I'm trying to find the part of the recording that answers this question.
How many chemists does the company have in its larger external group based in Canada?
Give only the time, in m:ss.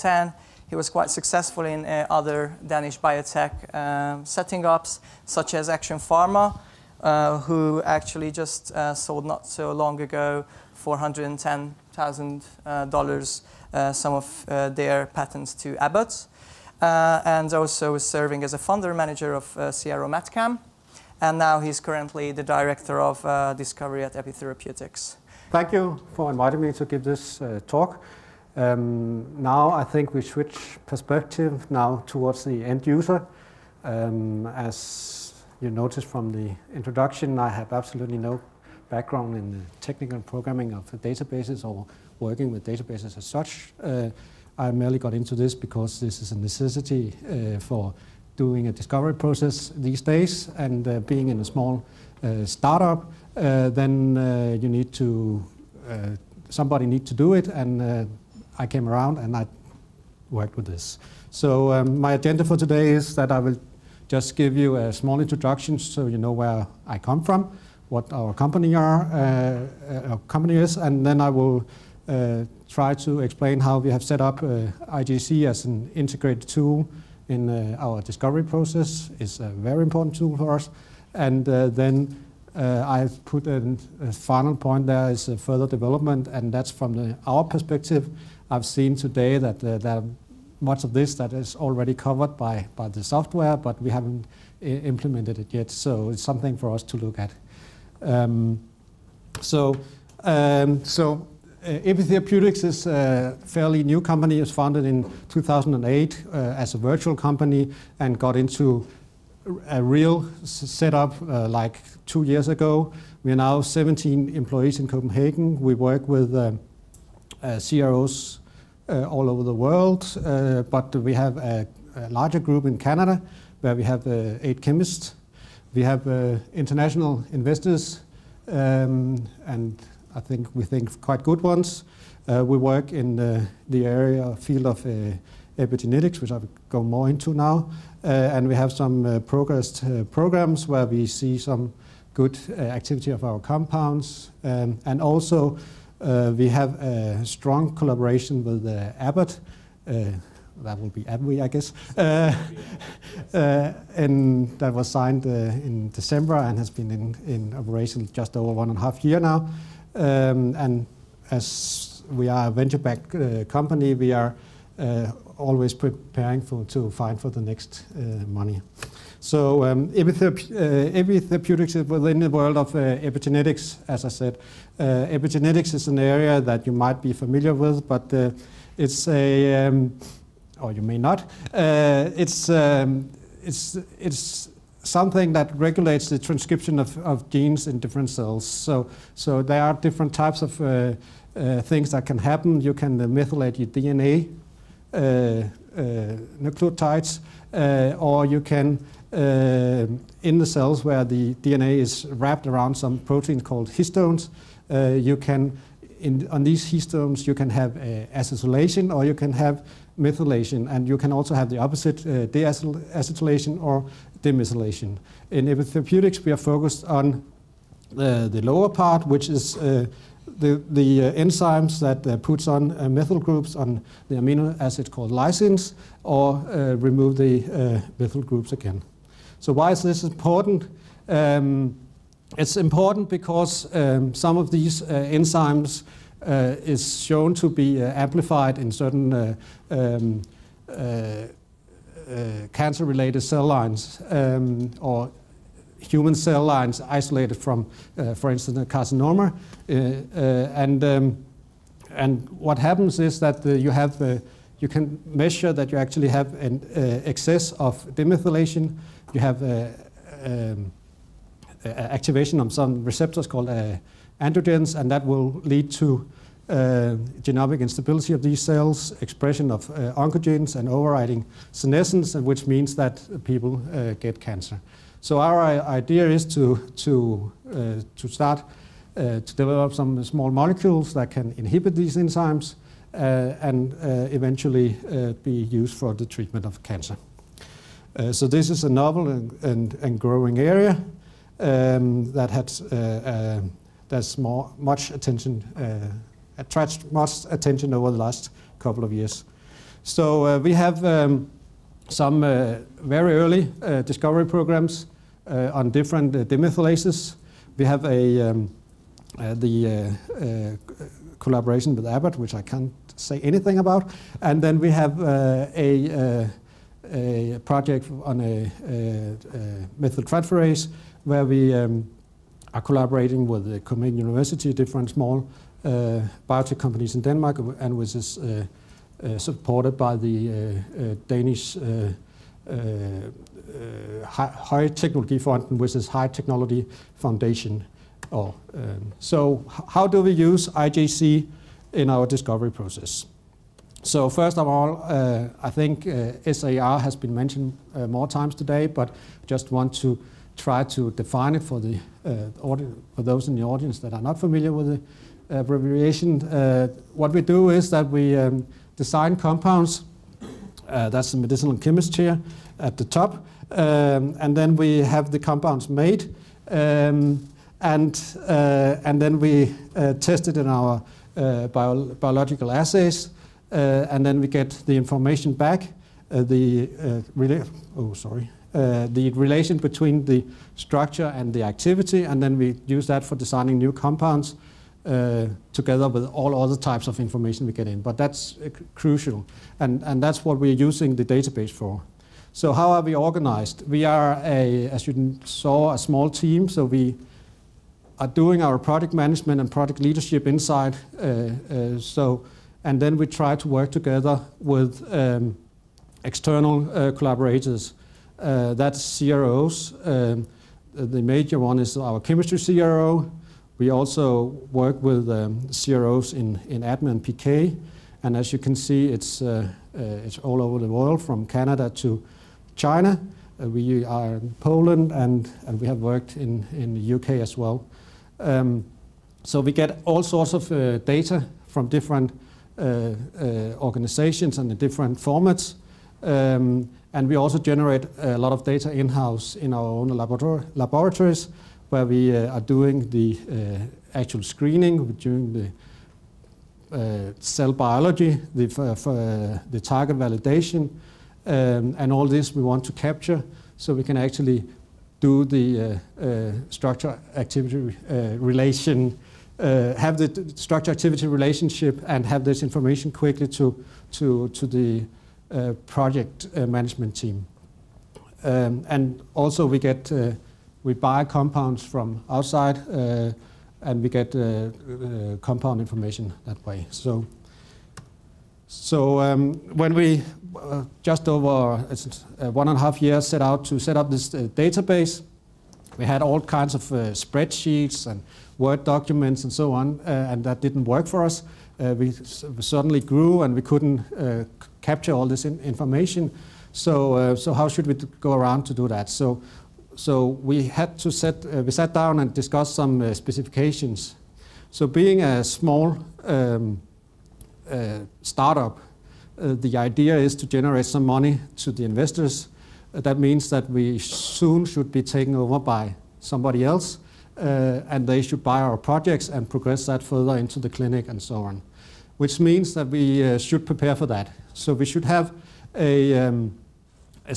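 2:04.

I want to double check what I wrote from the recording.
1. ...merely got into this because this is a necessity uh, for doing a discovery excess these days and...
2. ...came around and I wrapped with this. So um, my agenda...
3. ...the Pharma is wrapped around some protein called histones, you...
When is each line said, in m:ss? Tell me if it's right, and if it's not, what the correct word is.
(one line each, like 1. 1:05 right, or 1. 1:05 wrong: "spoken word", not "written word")
1. 0:44 wrong: "process", not "excess"
2. 0:58 wrong: "worked", not "wrapped"
3. 3:21 wrong: "DNA", not "Pharma".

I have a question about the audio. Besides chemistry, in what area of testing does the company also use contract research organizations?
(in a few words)
ADME PK.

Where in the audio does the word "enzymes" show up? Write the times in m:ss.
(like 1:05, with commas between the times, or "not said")
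3:41, 3:54, 4:41.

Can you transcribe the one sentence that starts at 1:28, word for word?
I've seen today that there much of this that is already covered by, by the software, but we haven't implemented it yet.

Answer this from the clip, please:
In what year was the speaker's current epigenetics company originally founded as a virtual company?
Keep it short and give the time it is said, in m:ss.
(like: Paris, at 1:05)
2008, at 1:45.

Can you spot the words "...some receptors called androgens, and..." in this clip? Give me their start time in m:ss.
4:22.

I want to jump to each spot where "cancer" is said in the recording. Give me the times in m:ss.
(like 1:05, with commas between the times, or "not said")
4:02, 4:34, 4:46.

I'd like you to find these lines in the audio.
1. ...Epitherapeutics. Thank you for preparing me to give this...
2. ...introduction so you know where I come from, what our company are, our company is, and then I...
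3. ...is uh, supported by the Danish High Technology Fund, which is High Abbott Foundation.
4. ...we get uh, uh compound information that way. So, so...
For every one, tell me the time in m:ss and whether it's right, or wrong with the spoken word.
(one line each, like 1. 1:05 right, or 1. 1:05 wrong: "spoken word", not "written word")
1. 0:24 wrong: "inviting", not "preparing"
2. 1:05 right
3. 5:27 wrong: "Technology", not "Abbott"
4. 7:53 right.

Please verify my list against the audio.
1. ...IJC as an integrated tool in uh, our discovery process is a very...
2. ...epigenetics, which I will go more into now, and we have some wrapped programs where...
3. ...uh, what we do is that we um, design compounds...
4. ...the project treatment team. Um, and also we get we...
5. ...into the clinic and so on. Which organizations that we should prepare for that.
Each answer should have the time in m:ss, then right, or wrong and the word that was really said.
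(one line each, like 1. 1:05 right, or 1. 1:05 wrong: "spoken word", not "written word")
1. 1:14 right
2. 2:15 wrong: "progressed", not "wrapped"
3. 5:56 right
4. 7:44 wrong: "management", not "treatment"
5. 8:40 wrong: "means", not "organizations".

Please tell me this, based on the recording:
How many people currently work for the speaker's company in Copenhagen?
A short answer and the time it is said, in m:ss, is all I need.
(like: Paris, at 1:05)
17, at 1:53.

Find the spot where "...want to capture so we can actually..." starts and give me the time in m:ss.
7:32.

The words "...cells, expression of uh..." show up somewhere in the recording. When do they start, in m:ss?
4:28.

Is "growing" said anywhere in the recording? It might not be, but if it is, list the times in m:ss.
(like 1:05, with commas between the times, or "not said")
4:49.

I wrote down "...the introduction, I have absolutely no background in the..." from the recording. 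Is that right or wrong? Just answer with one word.
right.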